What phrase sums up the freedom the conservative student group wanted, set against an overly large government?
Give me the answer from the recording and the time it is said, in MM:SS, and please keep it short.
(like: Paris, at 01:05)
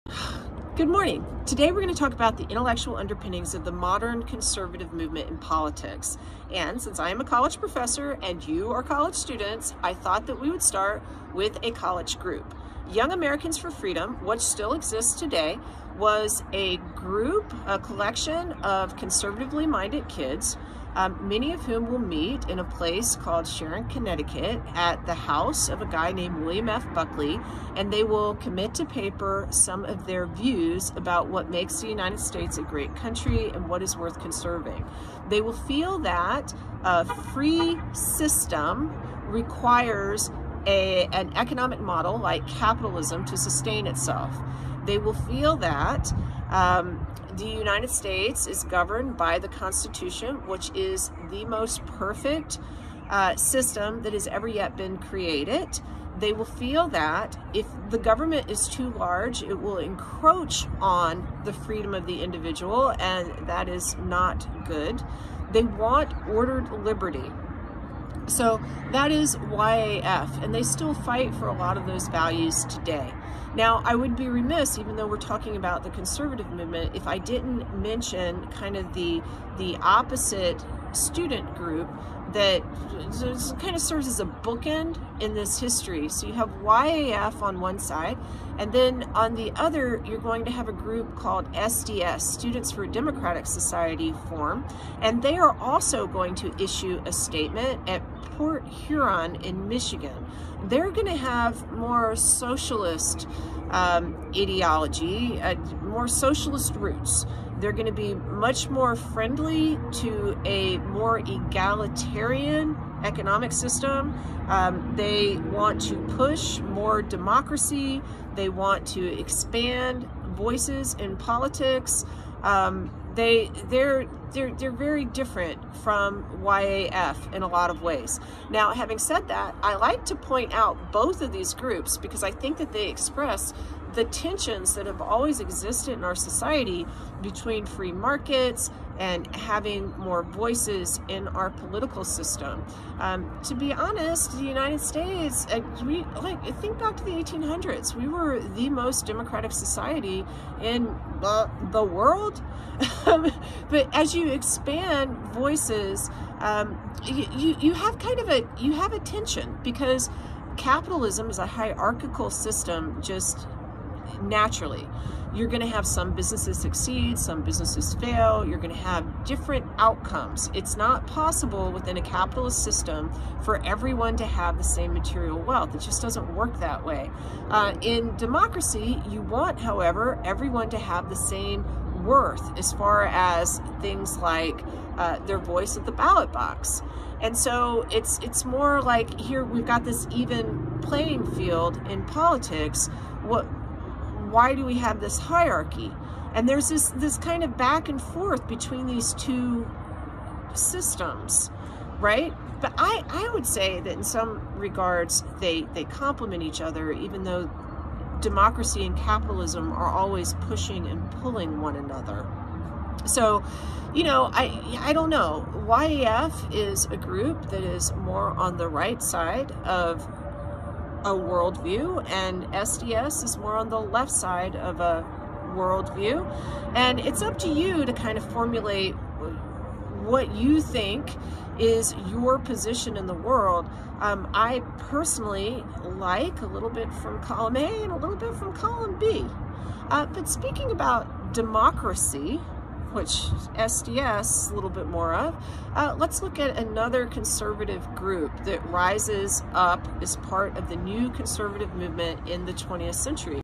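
ordered liberty, at 01:06.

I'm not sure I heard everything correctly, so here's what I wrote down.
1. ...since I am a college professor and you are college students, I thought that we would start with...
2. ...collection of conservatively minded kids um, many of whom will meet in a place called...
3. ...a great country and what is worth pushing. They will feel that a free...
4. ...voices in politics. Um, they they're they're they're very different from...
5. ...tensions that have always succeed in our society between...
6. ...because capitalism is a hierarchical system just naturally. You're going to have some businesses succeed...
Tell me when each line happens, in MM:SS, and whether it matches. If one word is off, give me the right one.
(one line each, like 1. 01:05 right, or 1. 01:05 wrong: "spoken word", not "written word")
1. 00:06 right
2. 00:17 right
3. 00:32 wrong: "conserving", not "pushing"
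4. 02:00 right
5. 02:14 wrong: "existed", not "succeed"
6. 02:39 right.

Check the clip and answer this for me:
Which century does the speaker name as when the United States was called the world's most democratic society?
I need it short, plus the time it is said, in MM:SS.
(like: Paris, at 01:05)
the 1800s, at 02:27.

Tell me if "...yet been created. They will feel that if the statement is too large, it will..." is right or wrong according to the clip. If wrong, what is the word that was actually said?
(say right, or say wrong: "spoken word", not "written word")
wrong: "government", not "statement".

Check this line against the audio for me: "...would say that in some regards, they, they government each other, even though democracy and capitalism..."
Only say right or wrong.
wrong.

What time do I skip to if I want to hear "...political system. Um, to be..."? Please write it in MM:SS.
02:21.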